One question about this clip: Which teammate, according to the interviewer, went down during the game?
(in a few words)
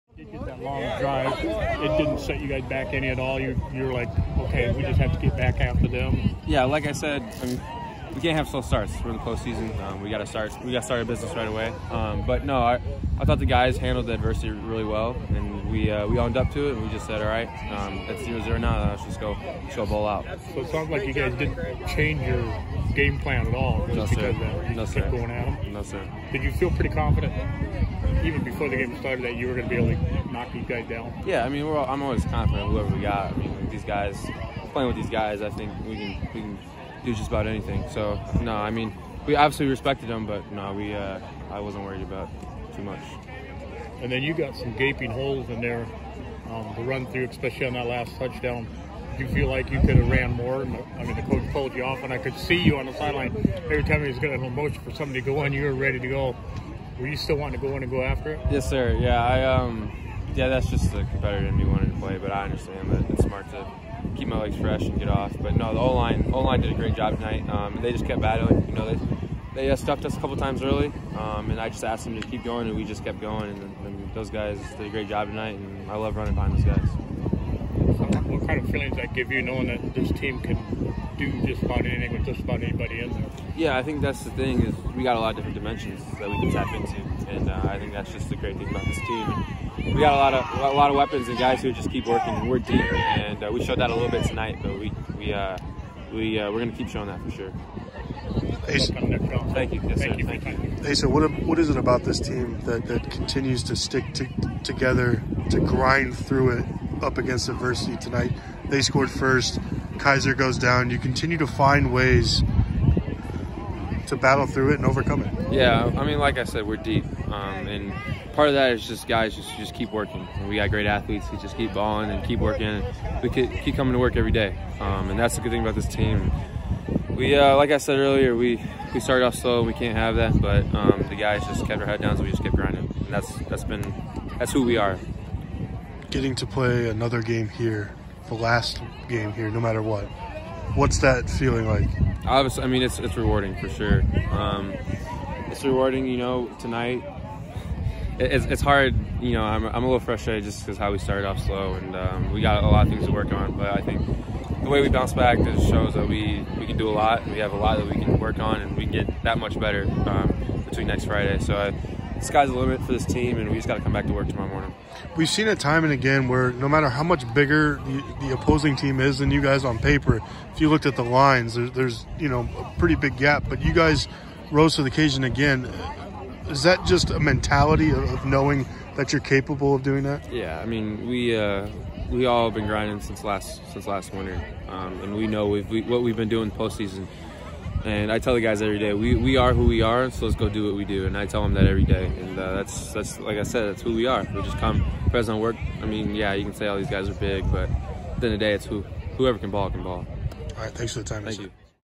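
Kaiser.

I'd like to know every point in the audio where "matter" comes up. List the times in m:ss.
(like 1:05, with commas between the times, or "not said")
2:19, 2:46.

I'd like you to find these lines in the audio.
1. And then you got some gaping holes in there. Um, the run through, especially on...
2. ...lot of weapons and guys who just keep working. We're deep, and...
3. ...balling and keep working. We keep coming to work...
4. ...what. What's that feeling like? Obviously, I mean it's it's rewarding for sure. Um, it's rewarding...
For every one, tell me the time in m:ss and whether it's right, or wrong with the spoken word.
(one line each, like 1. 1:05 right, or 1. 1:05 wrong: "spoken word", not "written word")
1. 0:44 right
2. 1:30 right
3. 2:01 right
4. 2:19 right.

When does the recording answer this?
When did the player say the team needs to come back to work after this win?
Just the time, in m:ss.
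2:44.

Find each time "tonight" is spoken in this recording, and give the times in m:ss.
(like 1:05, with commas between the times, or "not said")
1:07, 1:15, 1:34, 1:47, 2:26.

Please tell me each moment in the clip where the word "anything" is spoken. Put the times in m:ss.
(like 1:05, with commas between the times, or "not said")
0:37, 1:21.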